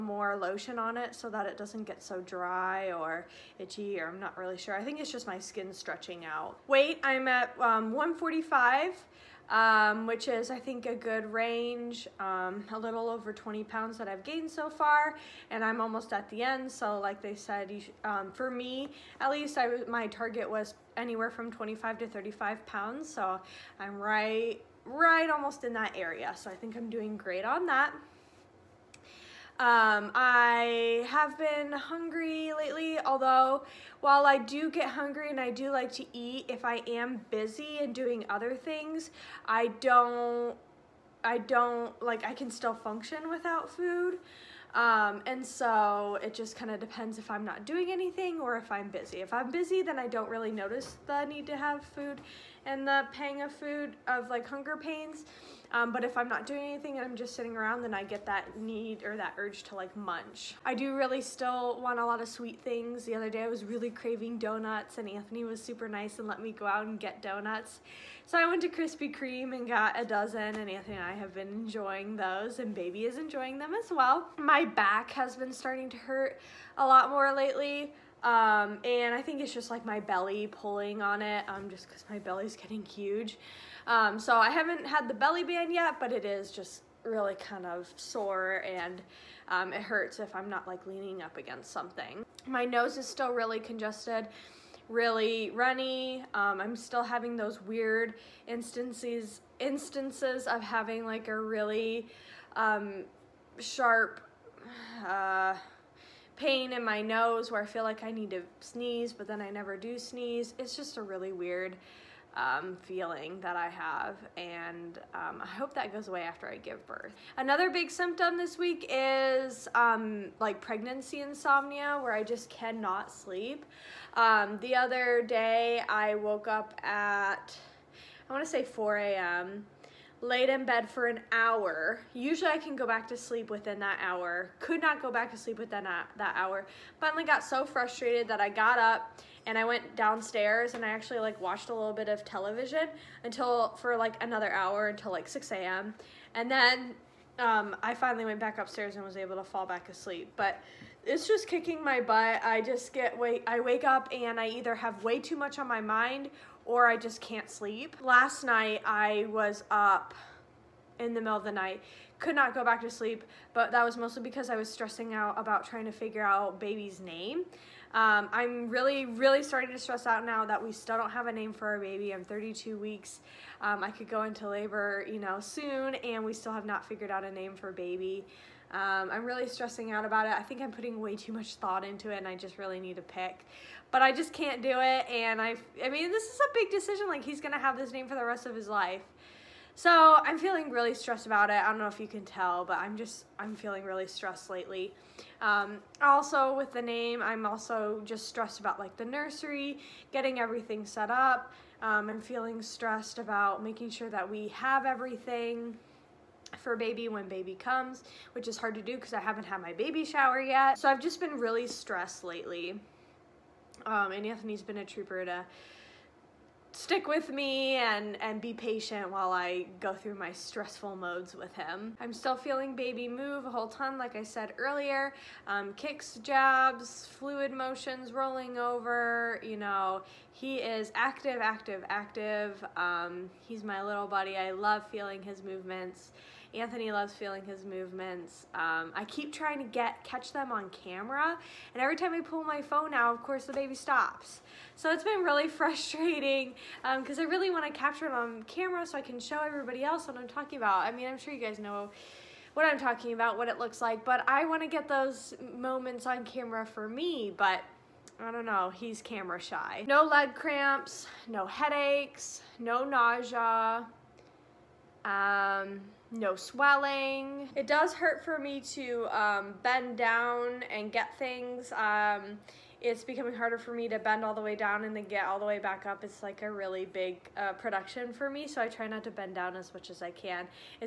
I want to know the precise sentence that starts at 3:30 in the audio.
So I've just been really stressed lately.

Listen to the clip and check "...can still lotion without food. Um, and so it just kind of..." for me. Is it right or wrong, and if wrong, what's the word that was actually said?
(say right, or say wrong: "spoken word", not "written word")
wrong: "function", not "lotion".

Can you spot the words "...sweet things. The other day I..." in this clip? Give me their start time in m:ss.
1:02.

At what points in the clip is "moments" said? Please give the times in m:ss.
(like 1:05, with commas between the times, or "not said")
4:15.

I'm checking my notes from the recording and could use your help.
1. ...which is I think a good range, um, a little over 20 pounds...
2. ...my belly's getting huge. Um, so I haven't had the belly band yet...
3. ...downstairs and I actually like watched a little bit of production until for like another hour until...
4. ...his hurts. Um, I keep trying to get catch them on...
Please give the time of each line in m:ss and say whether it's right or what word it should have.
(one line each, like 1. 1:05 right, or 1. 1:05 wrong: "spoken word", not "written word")
1. 0:10 right
2. 1:22 right
3. 2:19 wrong: "television", not "production"
4. 3:57 wrong: "movements", not "hurts".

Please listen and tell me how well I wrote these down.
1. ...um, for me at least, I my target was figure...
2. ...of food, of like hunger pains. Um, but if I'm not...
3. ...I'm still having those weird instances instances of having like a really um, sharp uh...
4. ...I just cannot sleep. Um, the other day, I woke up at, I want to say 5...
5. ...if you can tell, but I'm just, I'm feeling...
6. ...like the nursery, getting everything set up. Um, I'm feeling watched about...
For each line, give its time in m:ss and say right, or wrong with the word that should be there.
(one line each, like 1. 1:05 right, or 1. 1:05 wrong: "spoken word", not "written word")
1. 0:18 wrong: "anywhere", not "figure"
2. 0:53 right
3. 1:36 right
4. 2:02 wrong: "4", not "5"
5. 3:11 right
6. 3:18 wrong: "stressed", not "watched".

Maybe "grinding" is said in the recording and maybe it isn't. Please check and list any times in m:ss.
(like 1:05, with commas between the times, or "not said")
not said.